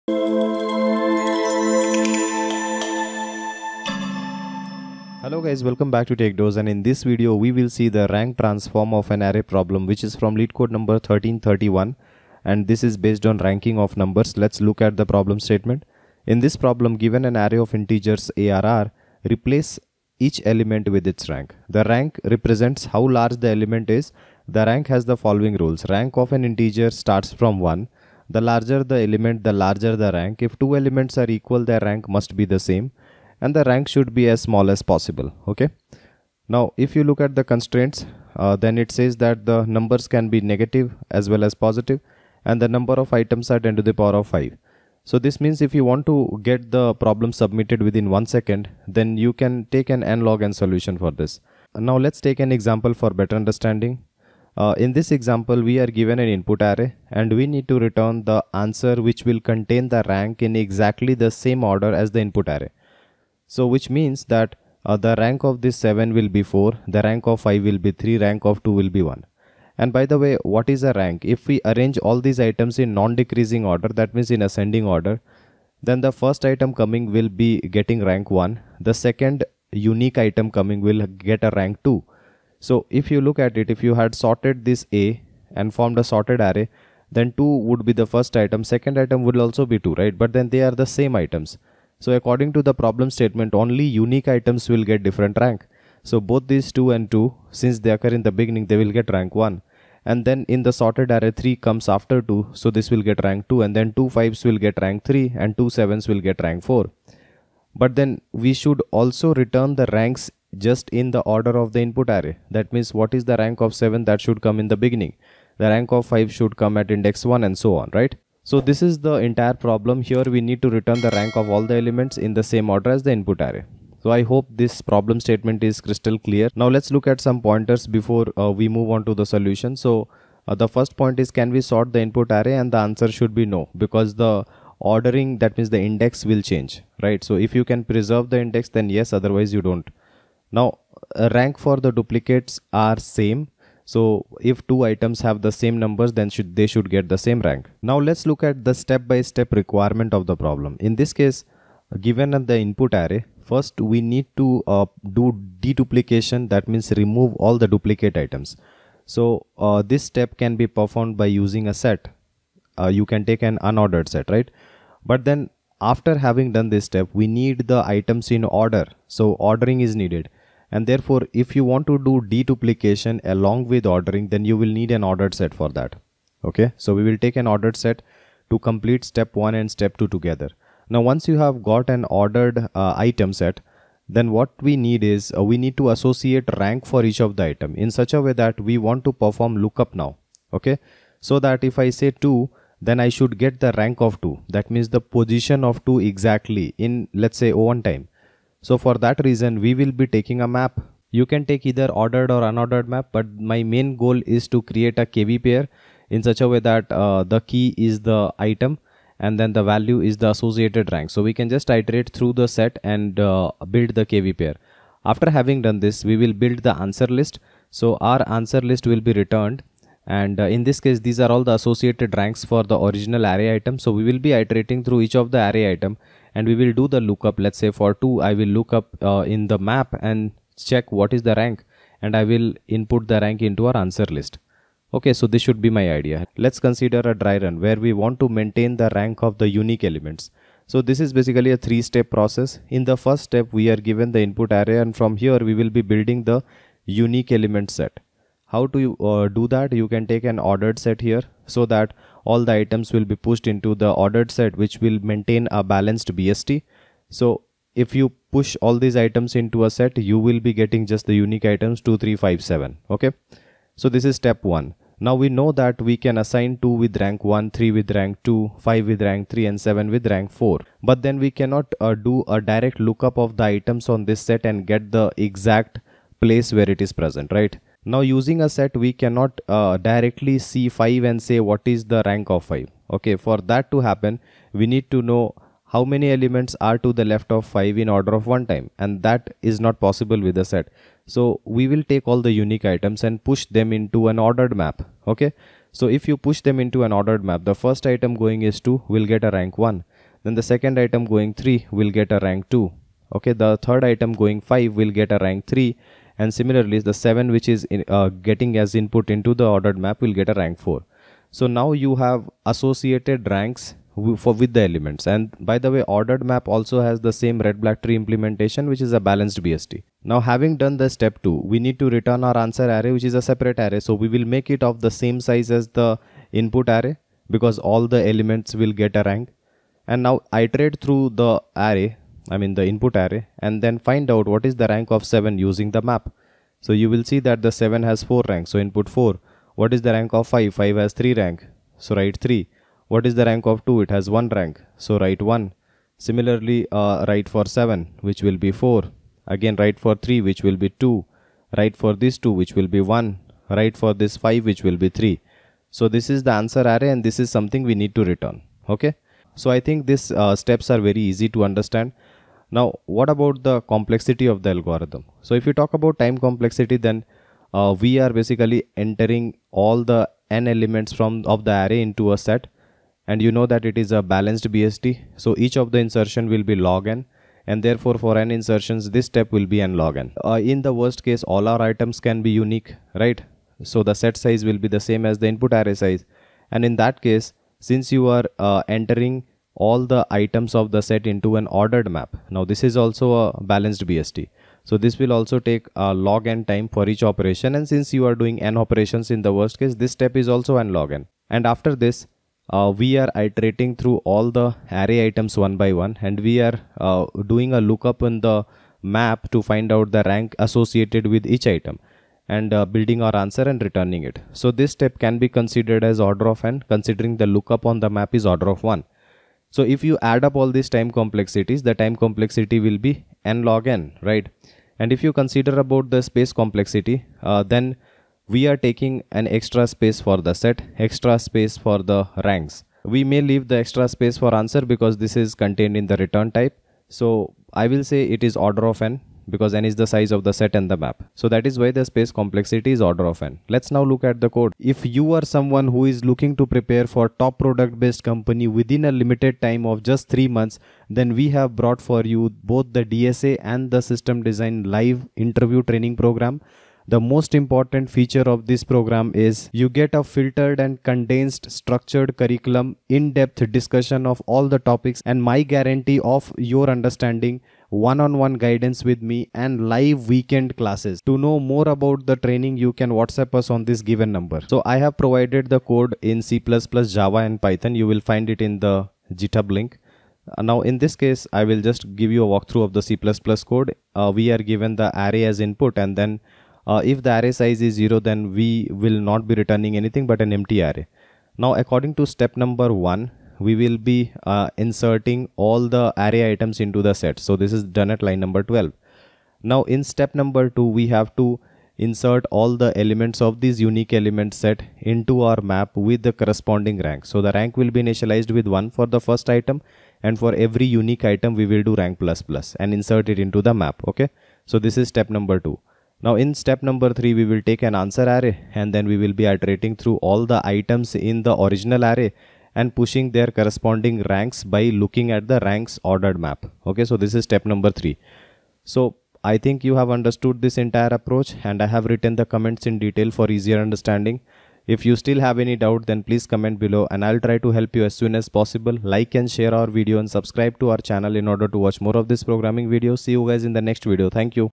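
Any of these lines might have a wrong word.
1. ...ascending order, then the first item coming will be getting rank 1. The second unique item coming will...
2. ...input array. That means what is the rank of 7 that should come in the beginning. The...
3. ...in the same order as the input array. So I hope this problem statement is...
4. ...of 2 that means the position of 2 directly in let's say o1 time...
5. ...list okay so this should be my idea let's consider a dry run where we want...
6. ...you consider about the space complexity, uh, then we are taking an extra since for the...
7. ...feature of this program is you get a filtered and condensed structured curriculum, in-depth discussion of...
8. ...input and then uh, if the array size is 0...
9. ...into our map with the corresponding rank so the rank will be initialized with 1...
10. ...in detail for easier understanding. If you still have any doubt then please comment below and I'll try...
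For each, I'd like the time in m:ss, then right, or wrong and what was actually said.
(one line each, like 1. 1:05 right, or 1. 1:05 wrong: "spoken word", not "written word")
1. 1:14 right
2. 1:51 right
3. 2:02 right
4. 3:14 wrong: "exactly", not "directly"
5. 3:54 right
6. 7:05 wrong: "space", not "since"
7. 7:37 right
8. 8:05 right
9. 8:24 right
10. 8:52 right.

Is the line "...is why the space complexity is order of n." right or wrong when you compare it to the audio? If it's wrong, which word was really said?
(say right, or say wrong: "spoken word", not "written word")
right.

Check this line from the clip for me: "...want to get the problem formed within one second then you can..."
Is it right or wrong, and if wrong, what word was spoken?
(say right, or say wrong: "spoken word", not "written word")
wrong: "submitted", not "formed".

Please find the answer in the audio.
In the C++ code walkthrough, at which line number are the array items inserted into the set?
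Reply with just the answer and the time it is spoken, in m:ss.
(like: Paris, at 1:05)
12, at 8:18.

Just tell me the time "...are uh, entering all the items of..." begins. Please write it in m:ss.
6:28.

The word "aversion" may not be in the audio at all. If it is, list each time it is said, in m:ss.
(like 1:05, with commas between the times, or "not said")
not said.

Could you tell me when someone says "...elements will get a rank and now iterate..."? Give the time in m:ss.
5:28.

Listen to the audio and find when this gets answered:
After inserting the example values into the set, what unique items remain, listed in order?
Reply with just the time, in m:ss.
4:21.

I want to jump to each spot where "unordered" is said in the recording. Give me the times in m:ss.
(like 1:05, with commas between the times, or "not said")
2:43, 3:22.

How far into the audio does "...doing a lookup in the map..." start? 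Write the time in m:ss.
6:47.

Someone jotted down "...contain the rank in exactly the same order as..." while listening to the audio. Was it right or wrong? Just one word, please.
right.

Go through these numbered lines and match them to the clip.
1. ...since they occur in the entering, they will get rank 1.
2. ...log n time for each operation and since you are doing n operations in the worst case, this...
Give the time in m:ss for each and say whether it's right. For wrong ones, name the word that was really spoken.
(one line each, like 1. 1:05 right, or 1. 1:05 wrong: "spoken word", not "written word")
1. 1:37 wrong: "beginning", not "entering"
2. 6:35 right.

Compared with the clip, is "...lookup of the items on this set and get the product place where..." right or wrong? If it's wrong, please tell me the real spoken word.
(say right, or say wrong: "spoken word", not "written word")
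wrong: "exact", not "product".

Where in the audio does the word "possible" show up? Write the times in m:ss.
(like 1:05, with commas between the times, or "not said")
0:34, 4:49, 8:58.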